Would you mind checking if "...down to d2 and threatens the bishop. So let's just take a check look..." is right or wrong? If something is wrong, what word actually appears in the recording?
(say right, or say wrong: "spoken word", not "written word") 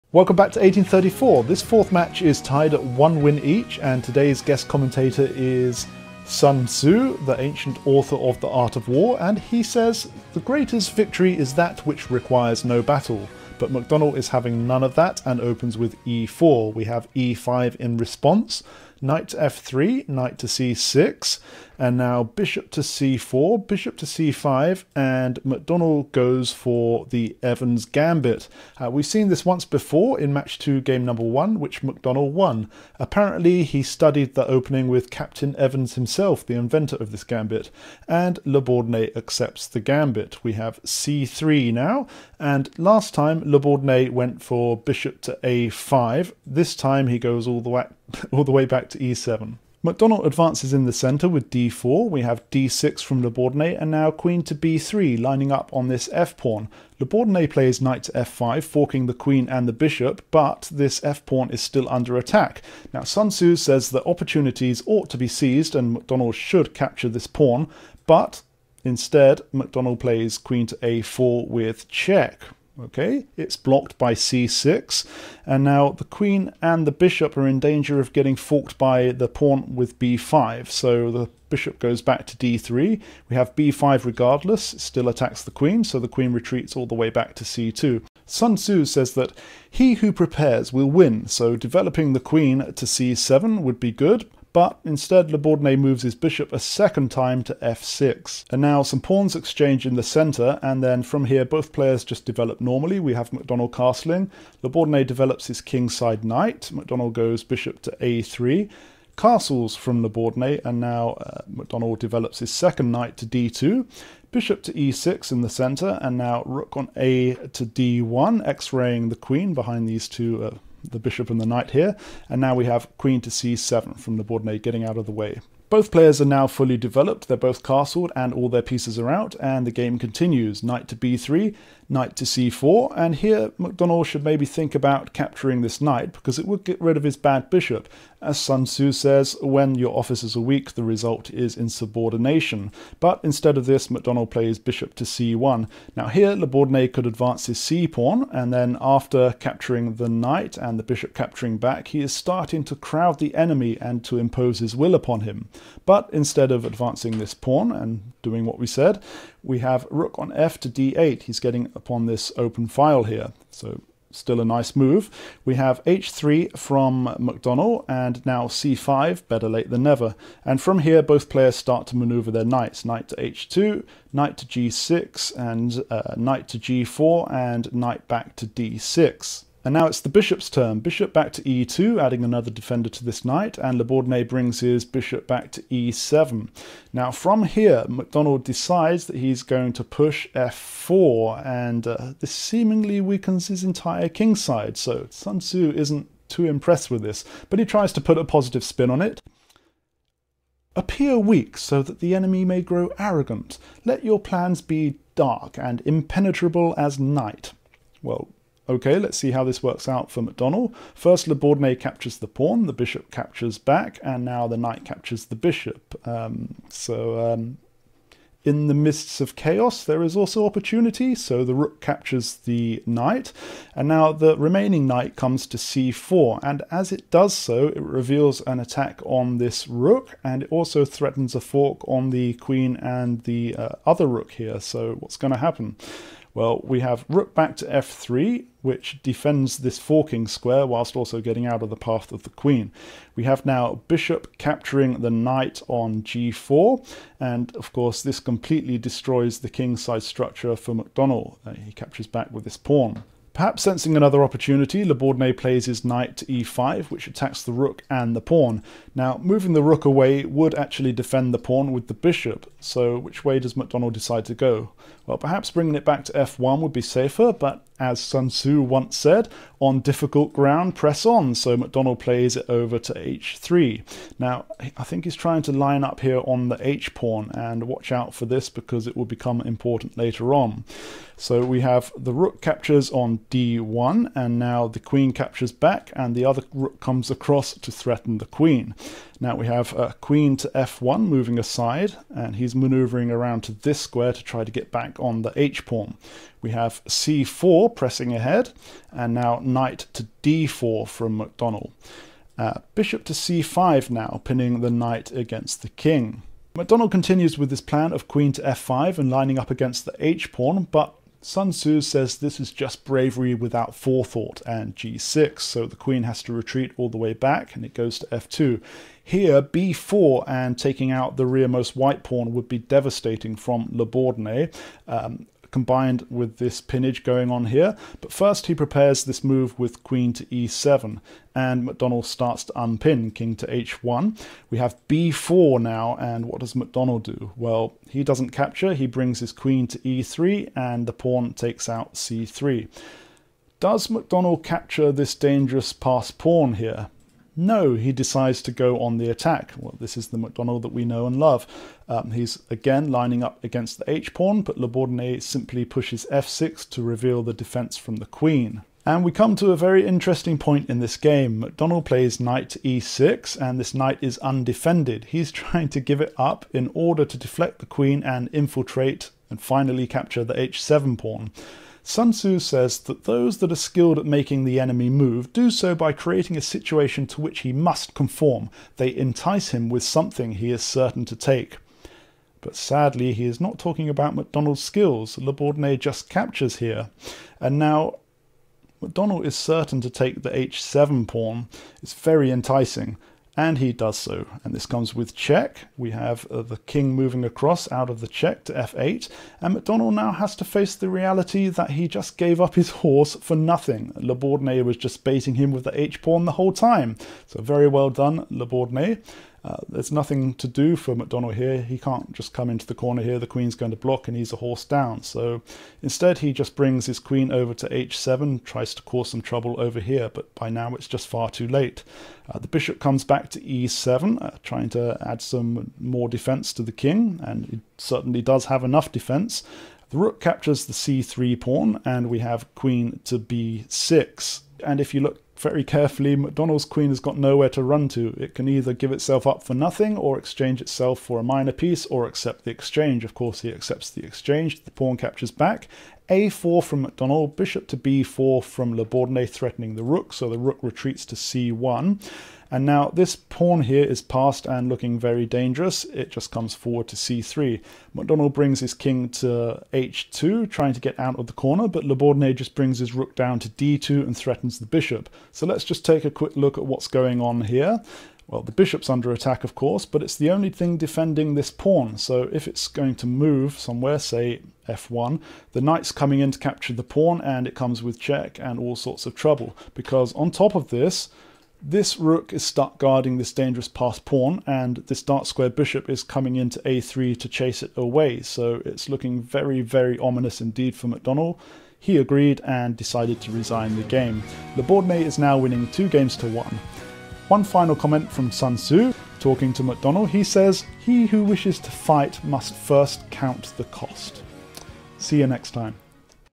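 wrong: "quick", not "check".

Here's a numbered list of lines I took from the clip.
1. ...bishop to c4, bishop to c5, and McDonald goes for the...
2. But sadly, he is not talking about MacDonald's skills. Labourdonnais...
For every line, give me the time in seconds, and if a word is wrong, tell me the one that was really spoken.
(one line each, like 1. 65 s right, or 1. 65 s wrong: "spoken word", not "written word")
1. 22 s right
2. 382 s right.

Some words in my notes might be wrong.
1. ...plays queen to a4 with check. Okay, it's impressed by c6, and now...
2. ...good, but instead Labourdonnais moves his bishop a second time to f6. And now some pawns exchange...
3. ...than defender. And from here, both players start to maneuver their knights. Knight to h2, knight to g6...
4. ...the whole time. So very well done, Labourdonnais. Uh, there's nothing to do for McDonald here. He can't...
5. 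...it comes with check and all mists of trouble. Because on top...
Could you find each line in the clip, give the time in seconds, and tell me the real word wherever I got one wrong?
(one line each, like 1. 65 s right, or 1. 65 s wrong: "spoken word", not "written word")
1. 69 s wrong: "blocked", not "impressed"
2. 93 s right
3. 169 s wrong: "never", not "defender"
4. 406 s right
5. 477 s wrong: "sorts", not "mists".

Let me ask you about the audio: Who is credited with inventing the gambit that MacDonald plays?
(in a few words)
Captain Evans.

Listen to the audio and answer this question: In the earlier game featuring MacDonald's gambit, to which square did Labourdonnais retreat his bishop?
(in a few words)
a5.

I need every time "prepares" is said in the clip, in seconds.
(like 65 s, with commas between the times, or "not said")
90 s, 328 s.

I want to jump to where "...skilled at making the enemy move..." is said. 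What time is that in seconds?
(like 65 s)
373 s.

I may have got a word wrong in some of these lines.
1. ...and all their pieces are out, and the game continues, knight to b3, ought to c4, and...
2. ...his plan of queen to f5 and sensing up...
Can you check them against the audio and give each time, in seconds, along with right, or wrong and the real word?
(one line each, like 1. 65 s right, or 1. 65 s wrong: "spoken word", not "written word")
1. 128 s wrong: "knight", not "ought"
2. 307 s wrong: "lining", not "sensing".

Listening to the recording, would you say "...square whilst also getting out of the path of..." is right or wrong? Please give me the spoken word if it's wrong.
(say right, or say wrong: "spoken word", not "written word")
right.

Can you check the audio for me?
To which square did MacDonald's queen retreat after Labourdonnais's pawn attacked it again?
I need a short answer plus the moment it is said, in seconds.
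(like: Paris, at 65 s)
c2, at 87 s.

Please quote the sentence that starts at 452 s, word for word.
And now this pawn here is passed and looking very dangerous.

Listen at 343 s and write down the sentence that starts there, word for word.
Does McDonald capture this dangerous passed pawn here?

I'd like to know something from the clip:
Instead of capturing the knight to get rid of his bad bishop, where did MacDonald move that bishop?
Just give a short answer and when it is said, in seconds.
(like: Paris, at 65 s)
c1, at 144 s.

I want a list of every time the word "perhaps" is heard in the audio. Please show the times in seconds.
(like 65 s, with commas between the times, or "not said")
253 s, 265 s.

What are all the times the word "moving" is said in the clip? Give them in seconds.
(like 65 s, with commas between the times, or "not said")
259 s, 291 s, 396 s.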